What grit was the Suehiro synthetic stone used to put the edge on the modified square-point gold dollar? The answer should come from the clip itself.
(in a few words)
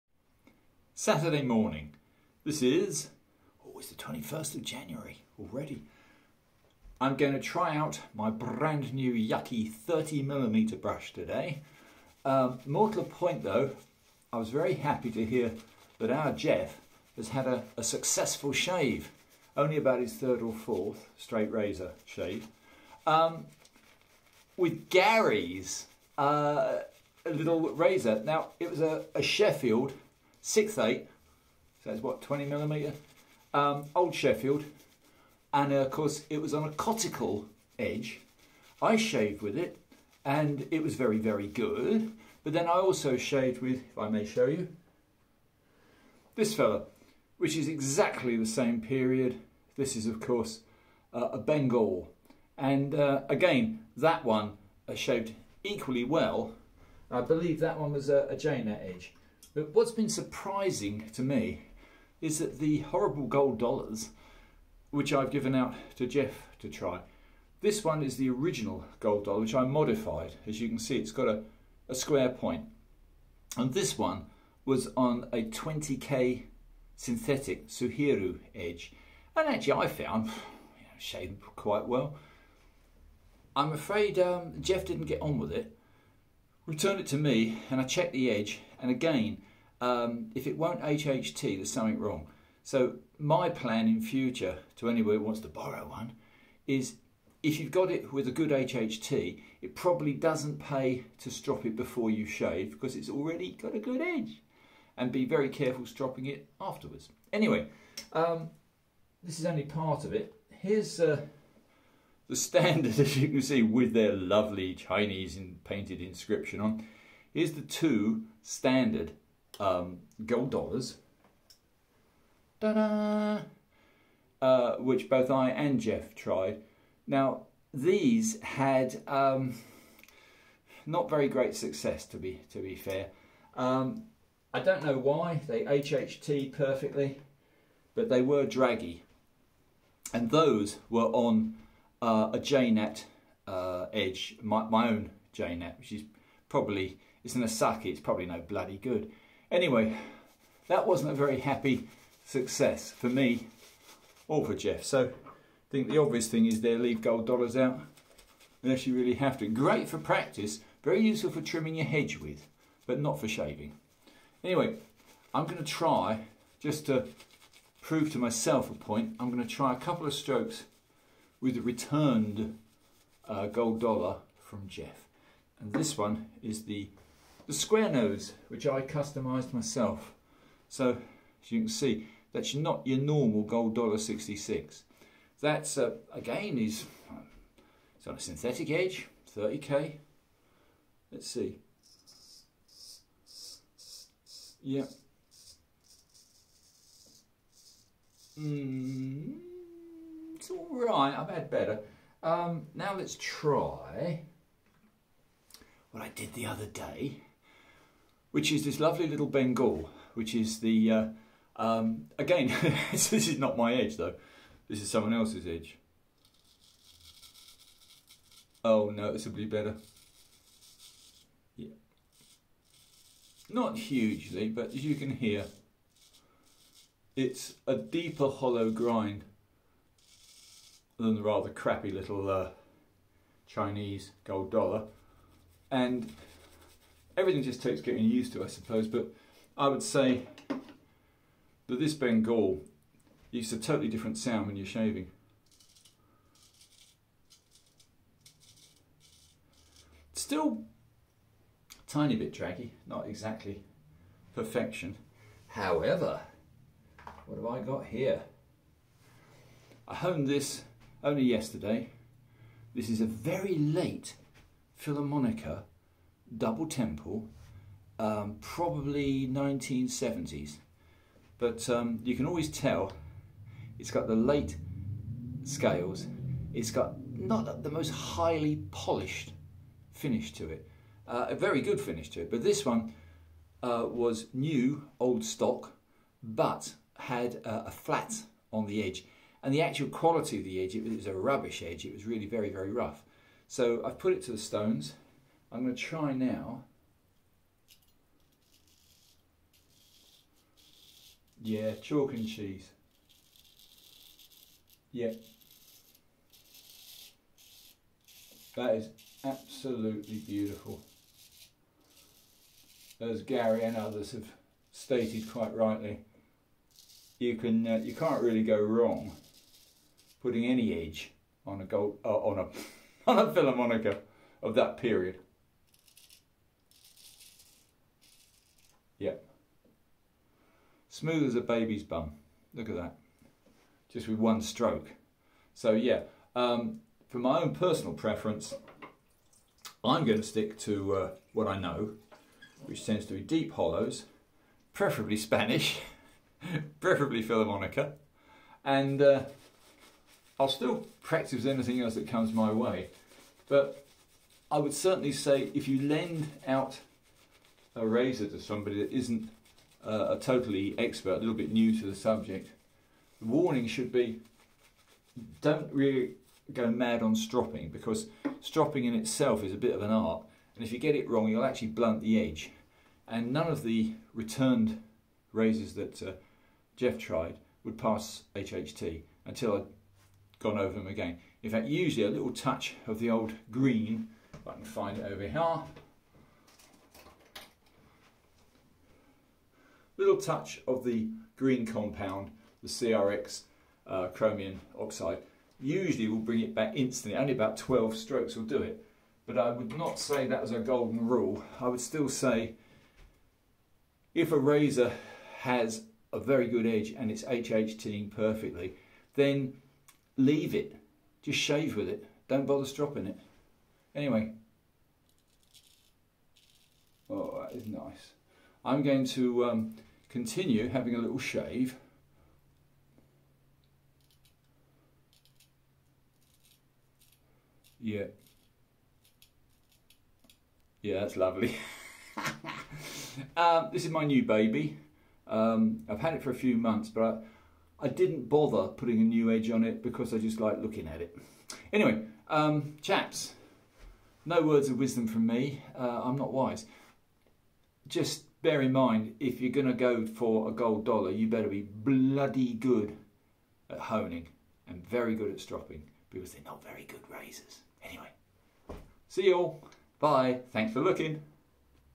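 20K.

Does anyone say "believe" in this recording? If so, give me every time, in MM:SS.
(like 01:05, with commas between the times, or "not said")
00:57.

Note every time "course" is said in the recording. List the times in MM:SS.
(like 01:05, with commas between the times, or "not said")
00:35, 00:50.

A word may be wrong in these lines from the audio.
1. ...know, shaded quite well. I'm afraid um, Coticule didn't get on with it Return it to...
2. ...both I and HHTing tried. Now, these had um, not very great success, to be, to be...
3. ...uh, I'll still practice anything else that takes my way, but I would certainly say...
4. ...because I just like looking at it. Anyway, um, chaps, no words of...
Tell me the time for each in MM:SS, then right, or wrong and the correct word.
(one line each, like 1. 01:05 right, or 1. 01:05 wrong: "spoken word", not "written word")
1. 01:20 wrong: "Jeff", not "Coticule"
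2. 02:05 wrong: "Jeff", not "HHTing"
3. 05:49 wrong: "comes", not "takes"
4. 07:19 right.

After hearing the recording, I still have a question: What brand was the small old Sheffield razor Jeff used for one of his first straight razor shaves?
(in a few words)
Six eight.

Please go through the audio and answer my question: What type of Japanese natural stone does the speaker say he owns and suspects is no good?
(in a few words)
Asagi.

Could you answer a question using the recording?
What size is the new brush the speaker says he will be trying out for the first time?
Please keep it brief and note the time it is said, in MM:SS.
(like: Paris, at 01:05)
30mm, at 00:09.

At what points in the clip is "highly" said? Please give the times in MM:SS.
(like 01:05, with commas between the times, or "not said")
04:37.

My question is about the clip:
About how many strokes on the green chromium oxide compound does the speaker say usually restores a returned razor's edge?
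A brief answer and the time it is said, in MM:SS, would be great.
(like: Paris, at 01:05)
12, at 06:37.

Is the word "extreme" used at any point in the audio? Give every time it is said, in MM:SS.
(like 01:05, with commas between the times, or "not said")
not said.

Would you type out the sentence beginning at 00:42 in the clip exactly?
But then I also shaved with, if I may show you, this fella, which is exactly the same period.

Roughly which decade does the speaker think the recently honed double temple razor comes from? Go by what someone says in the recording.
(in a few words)
1970s.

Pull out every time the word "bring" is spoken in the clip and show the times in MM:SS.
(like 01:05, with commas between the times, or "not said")
06:36.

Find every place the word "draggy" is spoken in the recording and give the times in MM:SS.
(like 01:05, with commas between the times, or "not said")
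02:18, 04:12.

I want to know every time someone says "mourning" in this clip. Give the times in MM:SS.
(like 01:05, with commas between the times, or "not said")
not said.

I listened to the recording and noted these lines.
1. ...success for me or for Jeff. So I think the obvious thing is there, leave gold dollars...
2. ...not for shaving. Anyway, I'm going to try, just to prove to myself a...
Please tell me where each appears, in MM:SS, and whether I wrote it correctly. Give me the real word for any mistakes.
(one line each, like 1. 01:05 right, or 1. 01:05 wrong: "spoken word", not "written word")
1. 02:32 right
2. 02:42 right.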